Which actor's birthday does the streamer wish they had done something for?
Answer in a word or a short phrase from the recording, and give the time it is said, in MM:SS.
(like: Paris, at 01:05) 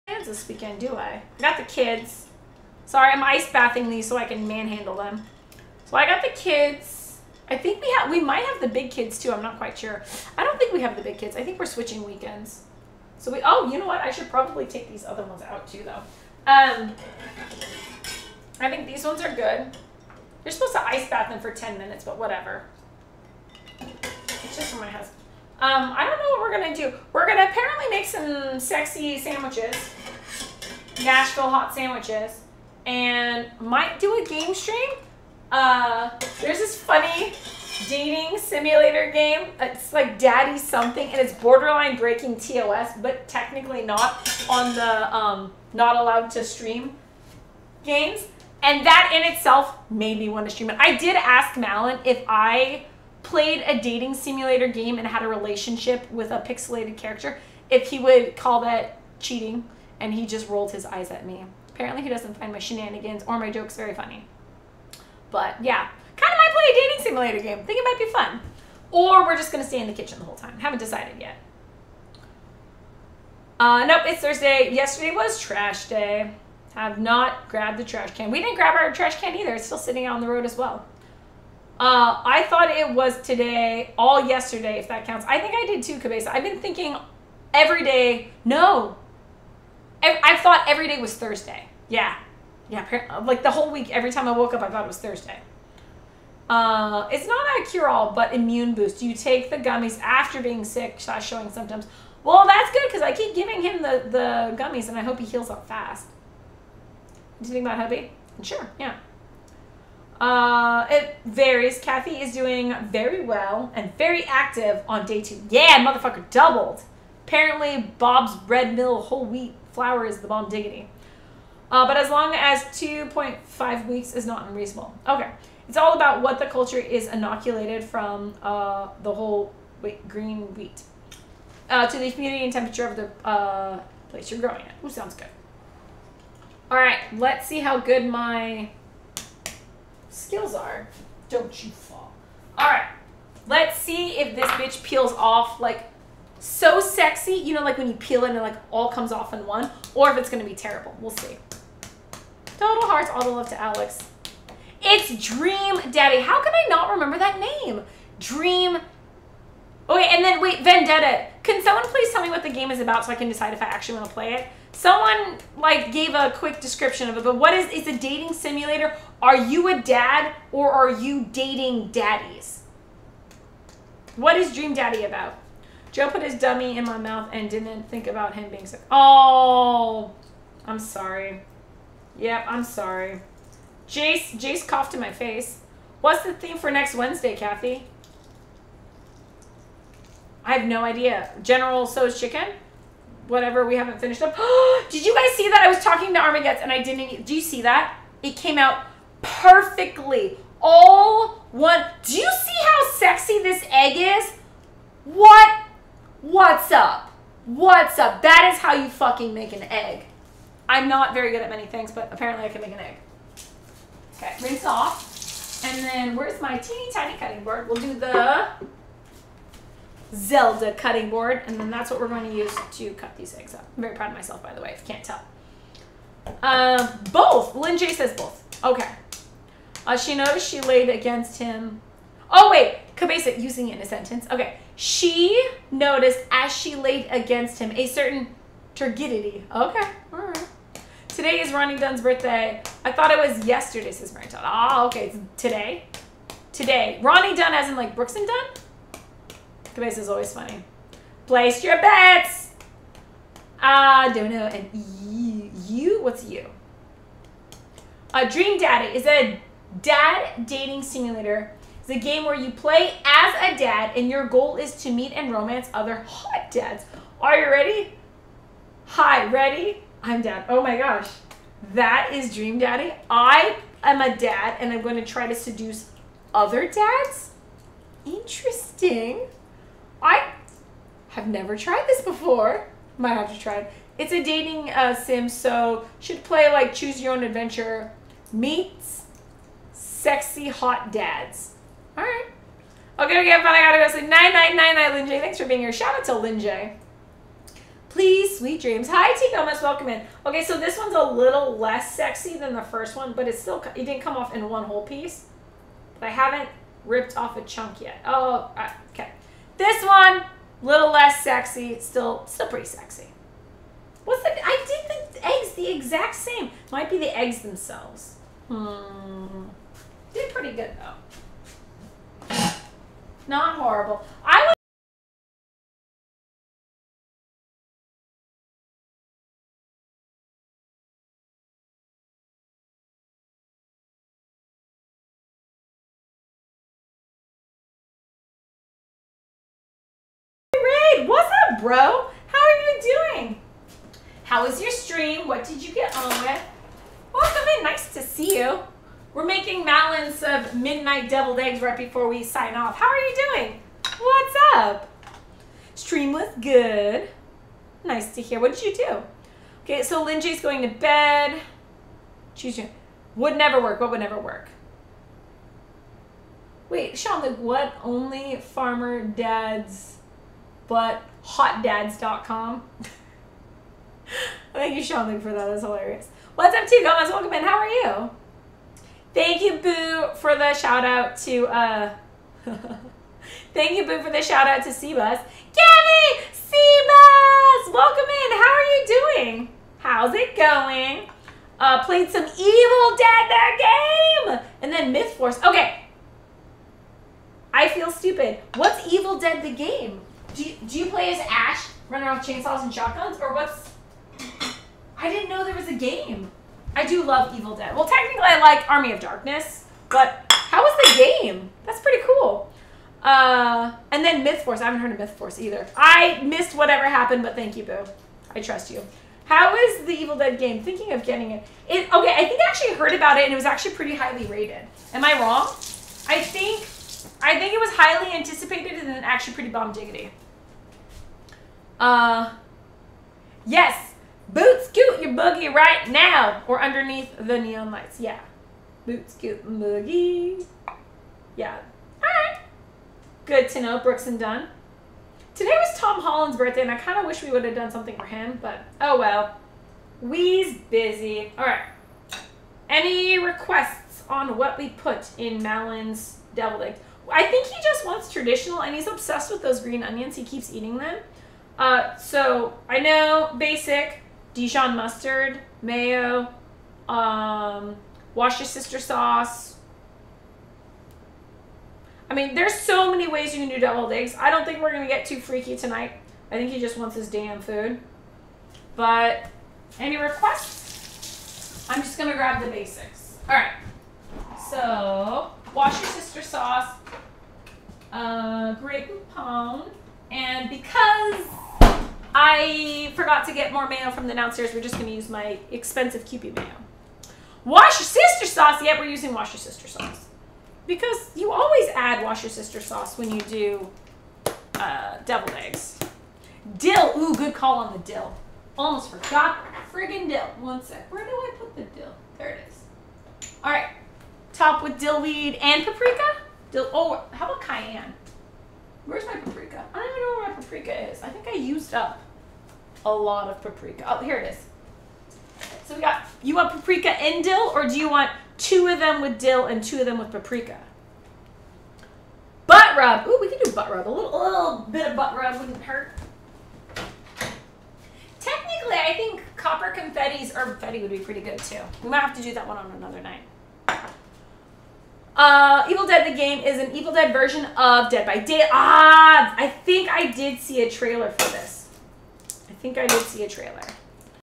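Tom Holland, at 07:25.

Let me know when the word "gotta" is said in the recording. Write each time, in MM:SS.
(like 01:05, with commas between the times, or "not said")
04:53.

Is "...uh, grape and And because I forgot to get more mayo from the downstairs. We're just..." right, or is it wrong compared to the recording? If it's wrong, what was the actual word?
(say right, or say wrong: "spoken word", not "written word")
right.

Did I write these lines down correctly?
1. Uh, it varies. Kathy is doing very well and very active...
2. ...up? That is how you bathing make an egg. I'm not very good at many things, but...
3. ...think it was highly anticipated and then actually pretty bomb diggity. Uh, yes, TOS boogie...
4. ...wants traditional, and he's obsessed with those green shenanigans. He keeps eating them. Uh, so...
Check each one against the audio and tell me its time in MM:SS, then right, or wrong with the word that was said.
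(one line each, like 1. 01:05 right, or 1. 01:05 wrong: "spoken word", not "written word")
1. 01:50 right
2. 03:27 wrong: "fucking", not "bathing"
3. 07:07 wrong: "Boots", not "TOS"
4. 07:37 wrong: "onions", not "shenanigans".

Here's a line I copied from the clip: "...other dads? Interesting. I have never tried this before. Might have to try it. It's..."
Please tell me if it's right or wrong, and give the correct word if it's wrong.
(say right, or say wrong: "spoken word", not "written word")
right.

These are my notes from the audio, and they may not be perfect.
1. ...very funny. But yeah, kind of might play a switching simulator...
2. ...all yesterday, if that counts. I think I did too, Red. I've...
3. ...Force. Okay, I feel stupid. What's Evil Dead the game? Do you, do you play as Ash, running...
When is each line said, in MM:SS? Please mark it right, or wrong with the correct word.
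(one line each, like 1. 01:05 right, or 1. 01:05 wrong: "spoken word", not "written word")
1. 01:03 wrong: "dating", not "switching"
2. 01:23 wrong: "Cabeza", not "Red"
3. 06:35 right.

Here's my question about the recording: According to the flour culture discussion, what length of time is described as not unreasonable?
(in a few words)
2.5 weeks.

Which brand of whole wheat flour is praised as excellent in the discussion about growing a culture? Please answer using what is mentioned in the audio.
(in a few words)
Bob's Red Mill.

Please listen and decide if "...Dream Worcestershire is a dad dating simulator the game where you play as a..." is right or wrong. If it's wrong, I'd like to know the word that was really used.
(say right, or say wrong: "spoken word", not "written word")
wrong: "Daddy", not "Worcestershire".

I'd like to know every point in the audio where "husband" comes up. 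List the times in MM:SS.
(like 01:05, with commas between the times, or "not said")
00:24.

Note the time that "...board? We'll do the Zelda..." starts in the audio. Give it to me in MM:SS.
03:37.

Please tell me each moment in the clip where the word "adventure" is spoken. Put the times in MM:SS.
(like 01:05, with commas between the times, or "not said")
04:47.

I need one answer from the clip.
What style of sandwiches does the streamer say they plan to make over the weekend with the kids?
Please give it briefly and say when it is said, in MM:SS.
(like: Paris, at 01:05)
Nashville hot, at 00:31.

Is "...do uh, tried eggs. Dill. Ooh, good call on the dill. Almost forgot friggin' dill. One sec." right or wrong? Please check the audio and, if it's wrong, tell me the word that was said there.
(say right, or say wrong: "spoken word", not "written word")
wrong: "deviled", not "tried".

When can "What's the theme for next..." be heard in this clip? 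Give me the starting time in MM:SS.
03:06.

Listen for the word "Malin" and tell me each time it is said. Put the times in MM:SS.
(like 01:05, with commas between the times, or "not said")
00:51, 07:35.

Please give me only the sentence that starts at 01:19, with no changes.
It's still sitting out on the road as well.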